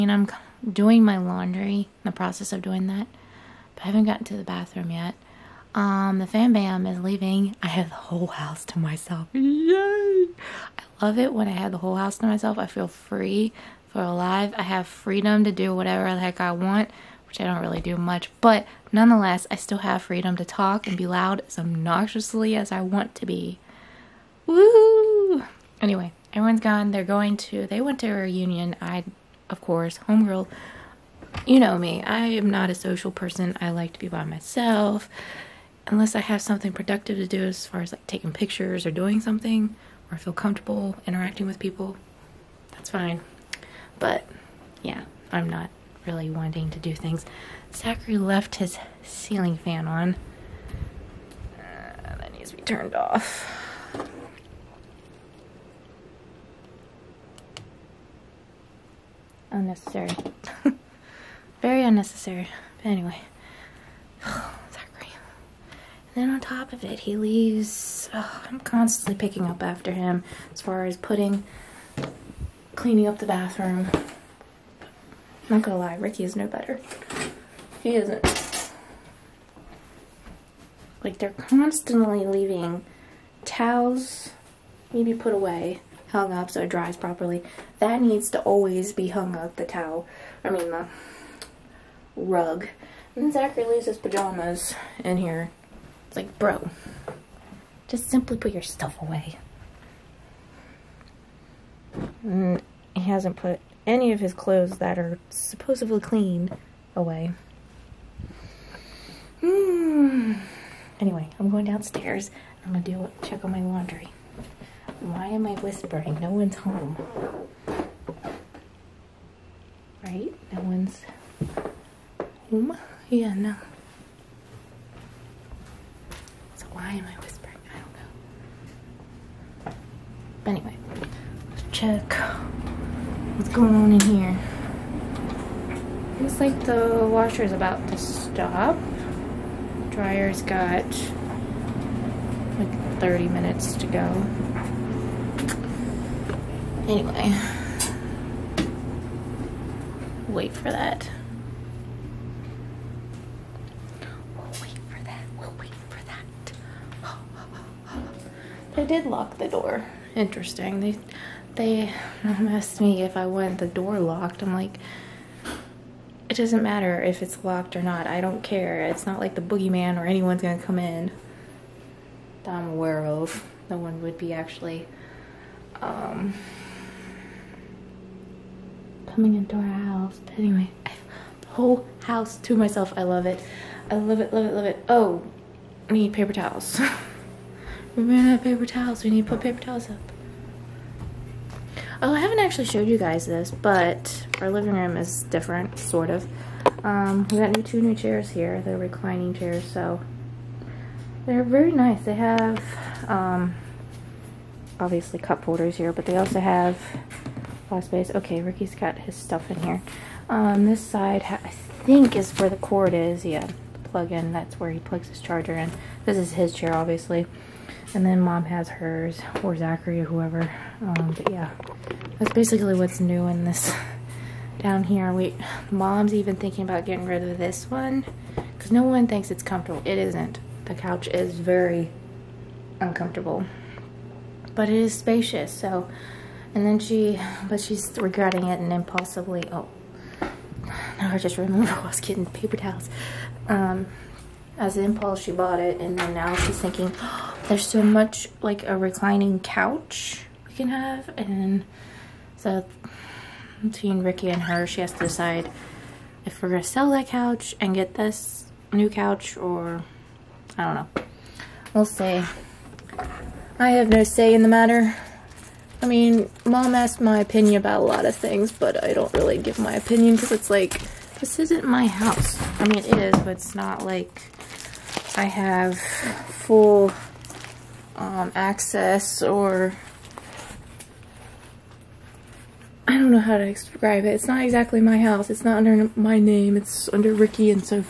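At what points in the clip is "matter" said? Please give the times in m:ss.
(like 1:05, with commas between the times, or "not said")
2:46, 4:24.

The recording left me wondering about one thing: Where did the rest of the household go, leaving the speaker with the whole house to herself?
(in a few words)
A reunion.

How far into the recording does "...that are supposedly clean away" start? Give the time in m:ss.
1:44.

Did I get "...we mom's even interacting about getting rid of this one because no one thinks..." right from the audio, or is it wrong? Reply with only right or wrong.
wrong.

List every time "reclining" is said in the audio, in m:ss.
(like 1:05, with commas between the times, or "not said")
3:18, 4:08.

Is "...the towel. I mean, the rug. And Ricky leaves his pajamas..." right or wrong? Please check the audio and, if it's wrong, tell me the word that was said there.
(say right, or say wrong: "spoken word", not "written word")
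wrong: "Zachary", not "Ricky".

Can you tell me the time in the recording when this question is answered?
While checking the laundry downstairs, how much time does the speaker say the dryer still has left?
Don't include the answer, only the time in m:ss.
2:22.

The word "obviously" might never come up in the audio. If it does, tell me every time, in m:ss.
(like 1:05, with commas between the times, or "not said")
3:24, 3:36.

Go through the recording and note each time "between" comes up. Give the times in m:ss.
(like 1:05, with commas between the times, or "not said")
4:13.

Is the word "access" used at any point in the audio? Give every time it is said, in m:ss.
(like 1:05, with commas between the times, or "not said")
4:38.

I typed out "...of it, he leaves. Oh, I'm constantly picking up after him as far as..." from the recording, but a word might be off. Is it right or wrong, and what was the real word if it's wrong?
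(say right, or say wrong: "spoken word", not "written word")
right.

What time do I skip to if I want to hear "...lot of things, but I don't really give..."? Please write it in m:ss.
4:27.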